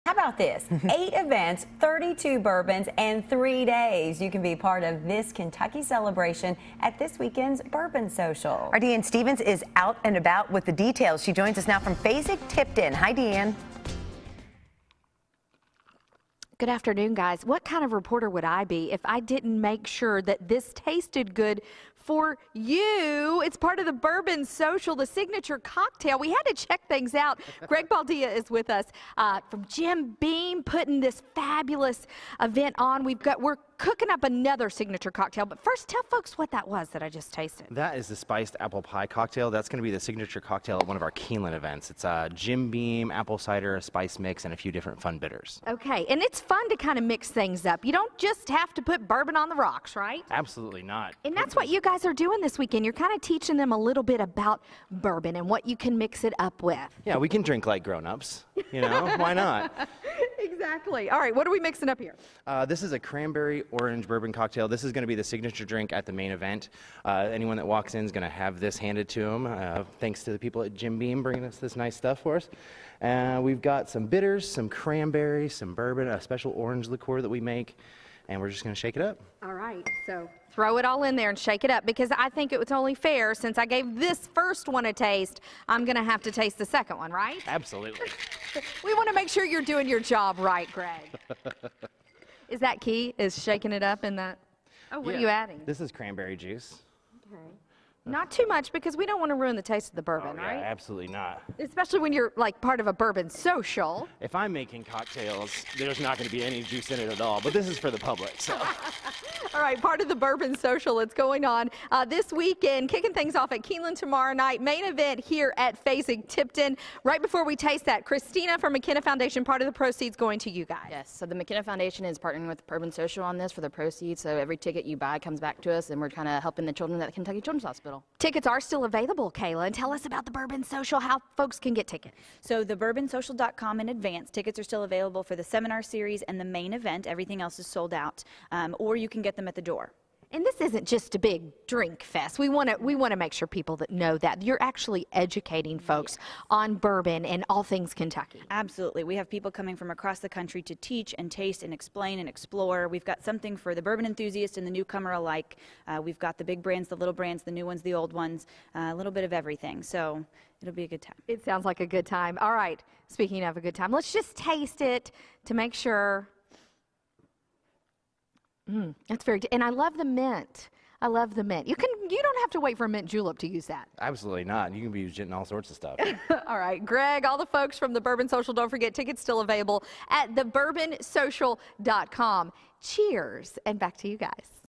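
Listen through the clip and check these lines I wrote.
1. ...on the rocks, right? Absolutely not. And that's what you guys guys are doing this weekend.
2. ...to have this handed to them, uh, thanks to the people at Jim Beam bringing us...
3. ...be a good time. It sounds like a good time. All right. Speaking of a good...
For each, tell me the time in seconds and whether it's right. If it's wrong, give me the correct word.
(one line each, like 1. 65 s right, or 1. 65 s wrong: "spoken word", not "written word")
1. 49 s right
2. 68 s right
3. 160 s right.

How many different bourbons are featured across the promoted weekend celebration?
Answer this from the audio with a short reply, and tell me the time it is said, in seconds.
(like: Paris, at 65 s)
32, at 1 s.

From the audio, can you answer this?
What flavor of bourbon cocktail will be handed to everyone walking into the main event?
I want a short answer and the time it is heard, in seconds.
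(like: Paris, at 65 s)
Cranberry orange, at 62 s.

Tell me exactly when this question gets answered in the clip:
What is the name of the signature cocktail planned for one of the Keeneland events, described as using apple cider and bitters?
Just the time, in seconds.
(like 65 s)
38 s.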